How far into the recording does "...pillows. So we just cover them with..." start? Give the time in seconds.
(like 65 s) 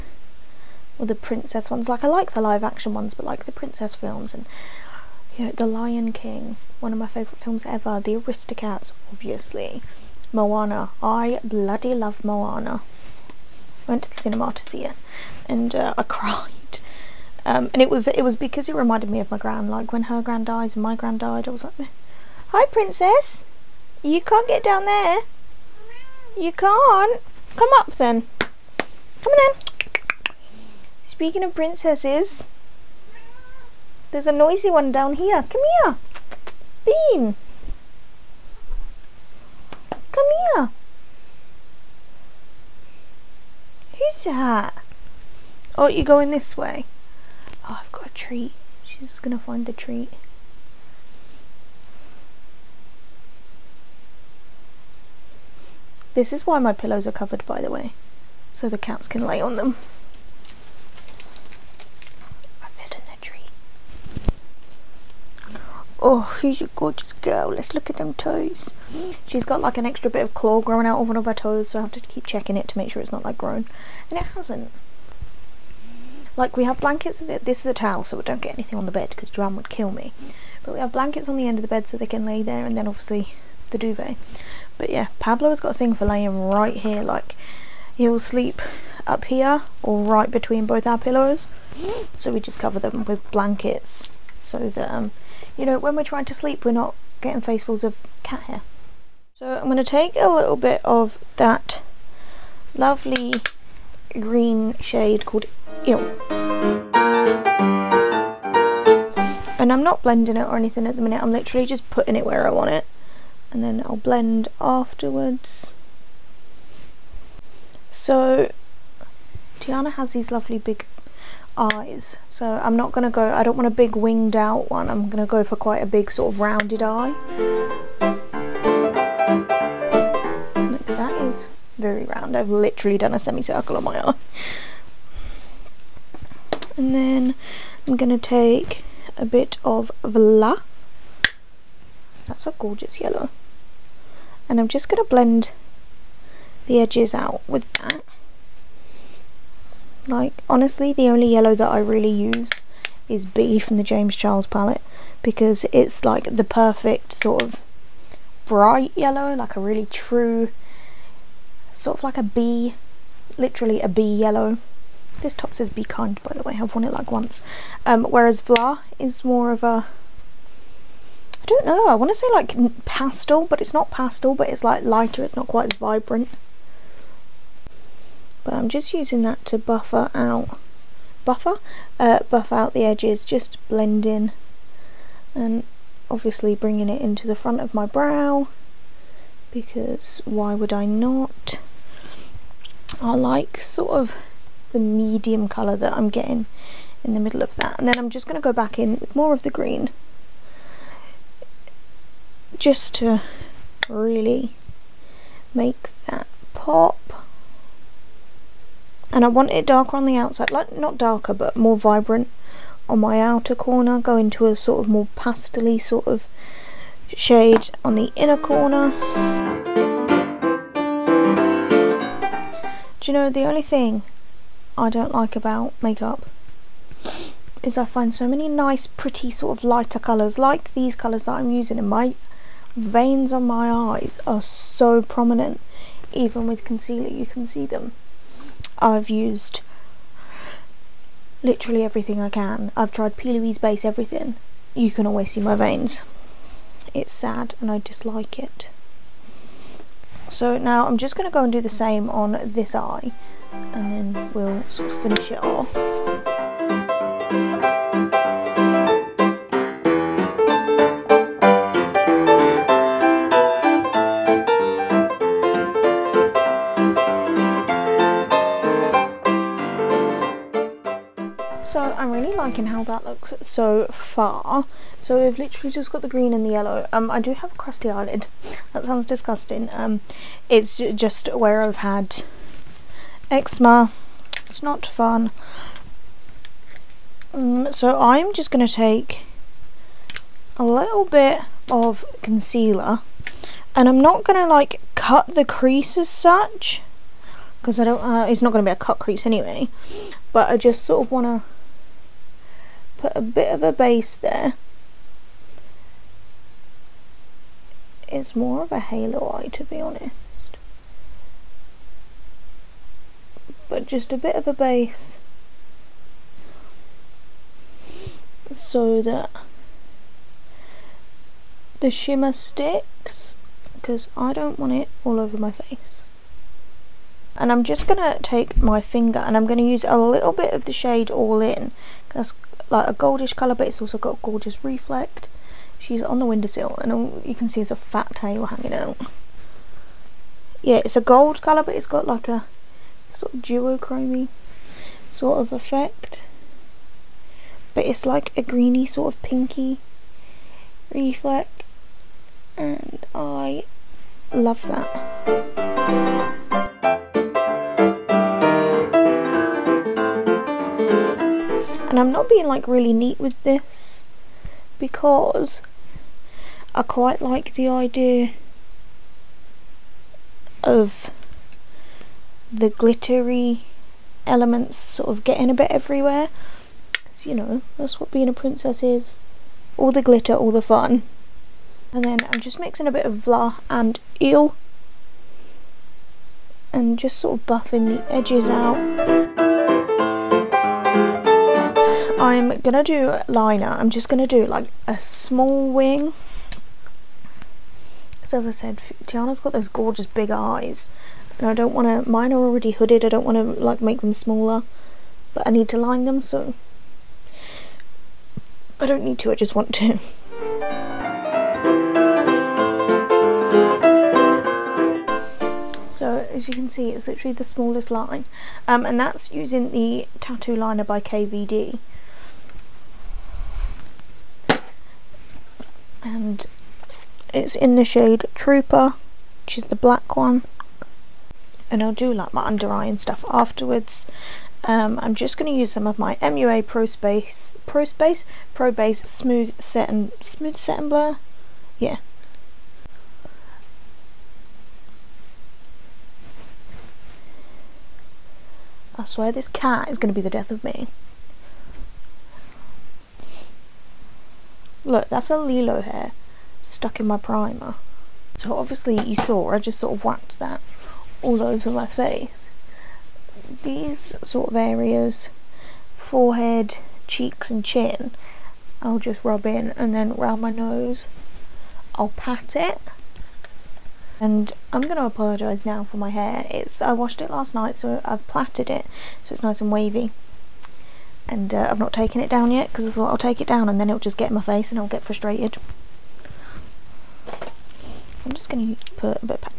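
90 s.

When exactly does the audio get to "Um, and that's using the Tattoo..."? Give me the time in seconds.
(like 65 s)
418 s.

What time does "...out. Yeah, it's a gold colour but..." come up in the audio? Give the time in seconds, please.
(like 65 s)
338 s.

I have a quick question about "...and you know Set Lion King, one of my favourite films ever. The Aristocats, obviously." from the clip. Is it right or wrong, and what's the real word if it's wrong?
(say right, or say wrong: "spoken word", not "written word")
wrong: "The", not "Set".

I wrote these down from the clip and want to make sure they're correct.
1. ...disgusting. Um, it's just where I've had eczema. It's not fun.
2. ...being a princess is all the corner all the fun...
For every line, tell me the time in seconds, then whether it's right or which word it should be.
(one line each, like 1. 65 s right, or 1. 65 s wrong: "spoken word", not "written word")
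1. 279 s right
2. 378 s wrong: "glitter", not "corner".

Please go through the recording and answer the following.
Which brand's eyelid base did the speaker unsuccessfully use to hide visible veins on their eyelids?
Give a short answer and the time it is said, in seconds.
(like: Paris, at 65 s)
P. Louise, at 243 s.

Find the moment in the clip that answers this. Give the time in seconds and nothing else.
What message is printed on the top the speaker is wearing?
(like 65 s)
165 s.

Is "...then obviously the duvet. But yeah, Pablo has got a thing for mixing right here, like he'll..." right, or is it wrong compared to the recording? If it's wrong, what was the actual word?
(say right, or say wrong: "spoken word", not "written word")
wrong: "laying", not "mixing".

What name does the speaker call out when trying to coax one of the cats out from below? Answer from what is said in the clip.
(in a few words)
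Bean.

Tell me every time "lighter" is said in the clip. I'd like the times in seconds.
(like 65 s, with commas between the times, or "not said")
174 s, 229 s.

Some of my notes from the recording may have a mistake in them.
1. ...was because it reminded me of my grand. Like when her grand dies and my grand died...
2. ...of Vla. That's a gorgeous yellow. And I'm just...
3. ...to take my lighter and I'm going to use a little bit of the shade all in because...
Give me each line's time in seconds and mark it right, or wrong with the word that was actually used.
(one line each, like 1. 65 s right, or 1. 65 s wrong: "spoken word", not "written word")
1. 18 s right
2. 139 s right
3. 327 s wrong: "finger", not "lighter".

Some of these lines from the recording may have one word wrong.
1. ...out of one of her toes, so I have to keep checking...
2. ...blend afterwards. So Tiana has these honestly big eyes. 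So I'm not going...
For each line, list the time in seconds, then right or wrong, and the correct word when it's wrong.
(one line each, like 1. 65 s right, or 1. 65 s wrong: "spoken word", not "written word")
1. 70 s right
2. 113 s wrong: "lovely", not "honestly".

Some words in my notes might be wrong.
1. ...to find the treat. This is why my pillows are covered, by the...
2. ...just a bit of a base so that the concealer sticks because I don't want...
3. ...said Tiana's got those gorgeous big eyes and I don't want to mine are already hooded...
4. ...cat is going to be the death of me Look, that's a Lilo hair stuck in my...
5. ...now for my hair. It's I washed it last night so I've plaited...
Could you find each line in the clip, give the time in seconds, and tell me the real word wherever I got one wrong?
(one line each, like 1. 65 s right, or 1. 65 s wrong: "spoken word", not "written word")
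1. 49 s right
2. 313 s wrong: "shimmer", not "concealer"
3. 398 s right
4. 449 s right
5. 475 s right.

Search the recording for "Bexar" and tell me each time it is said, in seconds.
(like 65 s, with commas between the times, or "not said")
not said.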